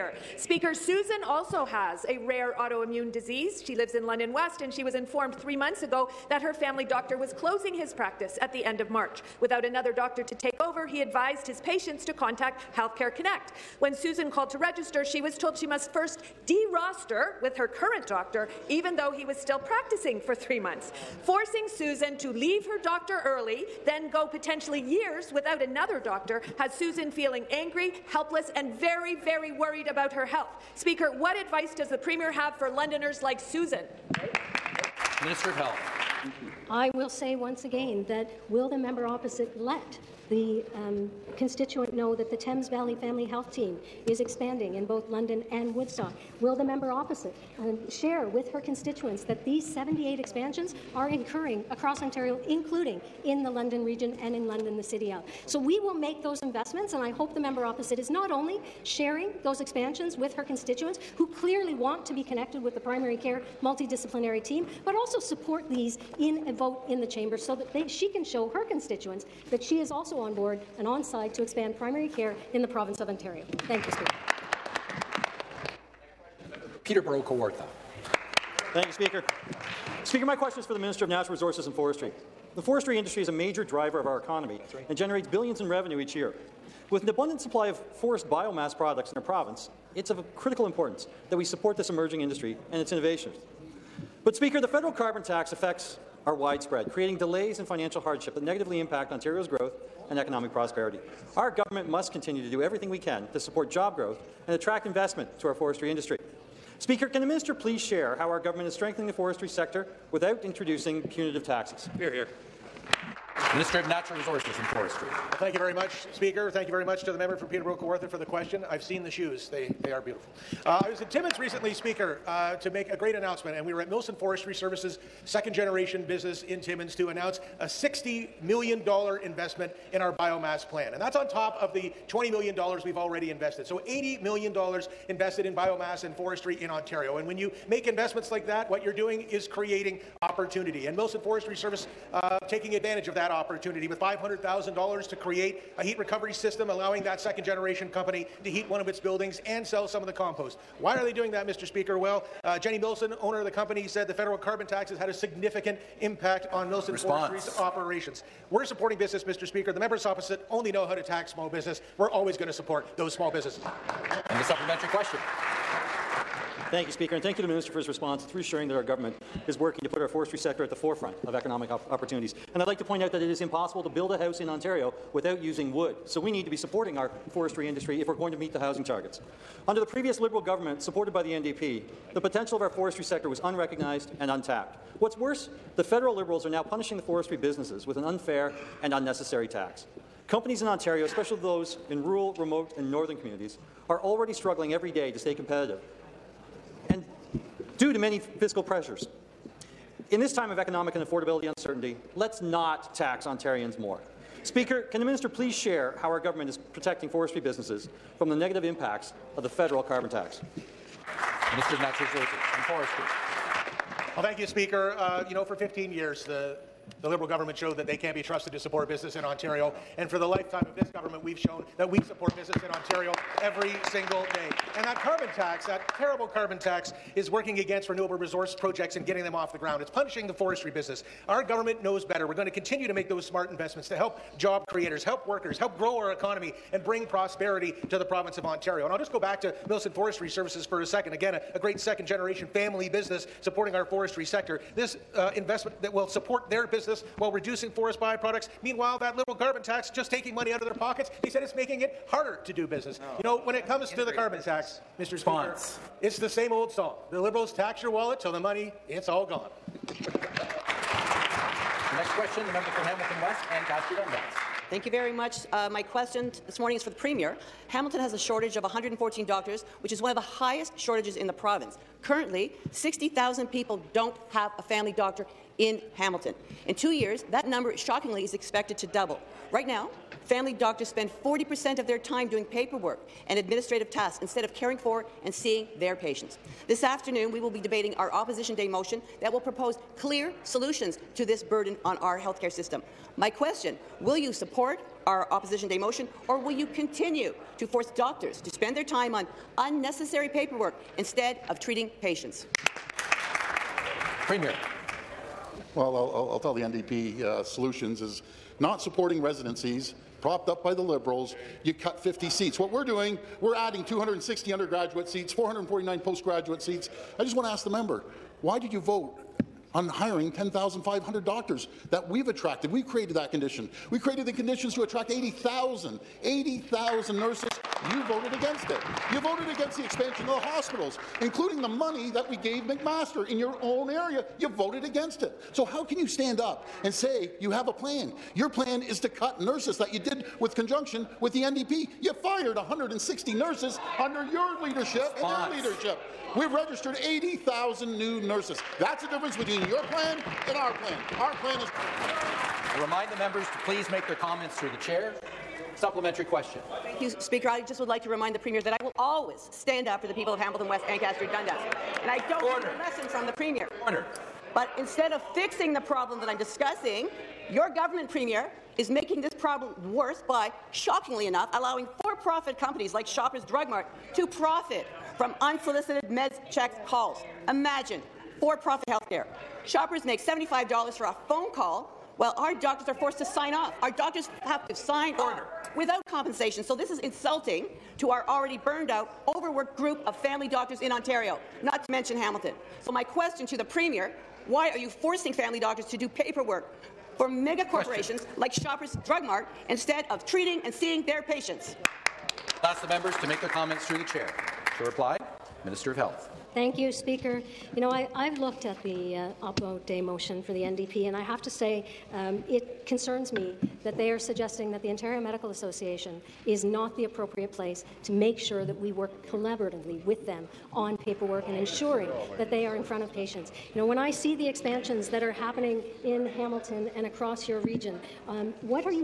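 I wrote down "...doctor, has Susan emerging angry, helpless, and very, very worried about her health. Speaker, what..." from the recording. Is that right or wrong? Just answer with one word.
wrong.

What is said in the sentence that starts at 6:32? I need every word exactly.
So my question to the Premier, why are you forcing family doctors to do paperwork for mega corporations question.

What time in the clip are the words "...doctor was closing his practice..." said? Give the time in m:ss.
0:06.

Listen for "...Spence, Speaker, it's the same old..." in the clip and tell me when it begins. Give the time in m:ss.
4:15.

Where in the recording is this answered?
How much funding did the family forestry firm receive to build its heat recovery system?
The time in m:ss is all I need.
2:23.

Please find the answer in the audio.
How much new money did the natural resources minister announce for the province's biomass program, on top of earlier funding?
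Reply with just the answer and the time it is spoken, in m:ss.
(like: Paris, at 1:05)
$60 million, at 2:07.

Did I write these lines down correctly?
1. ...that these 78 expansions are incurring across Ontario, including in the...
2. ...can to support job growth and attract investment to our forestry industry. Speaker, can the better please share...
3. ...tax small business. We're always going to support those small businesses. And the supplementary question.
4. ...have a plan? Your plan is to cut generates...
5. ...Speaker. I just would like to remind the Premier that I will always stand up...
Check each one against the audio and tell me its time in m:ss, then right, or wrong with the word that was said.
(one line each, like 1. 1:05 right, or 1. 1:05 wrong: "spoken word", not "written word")
1. 0:49 right
2. 1:42 wrong: "minister", not "better"
3. 2:41 right
4. 5:37 wrong: "nurses", not "generates"
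5. 5:57 right.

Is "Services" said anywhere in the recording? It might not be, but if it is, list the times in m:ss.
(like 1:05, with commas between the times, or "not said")
2:04, 2:21, 4:00.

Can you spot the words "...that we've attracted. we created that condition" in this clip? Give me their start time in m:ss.
5:21.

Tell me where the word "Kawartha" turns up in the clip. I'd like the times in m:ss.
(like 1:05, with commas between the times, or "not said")
1:17, 1:57.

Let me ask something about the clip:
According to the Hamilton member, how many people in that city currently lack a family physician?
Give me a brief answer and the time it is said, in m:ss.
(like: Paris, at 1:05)
60,000, at 4:32.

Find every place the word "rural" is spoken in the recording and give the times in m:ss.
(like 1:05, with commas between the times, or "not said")
3:12.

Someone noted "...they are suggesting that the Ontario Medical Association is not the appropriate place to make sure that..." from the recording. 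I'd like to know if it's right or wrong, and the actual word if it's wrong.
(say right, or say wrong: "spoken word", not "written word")
right.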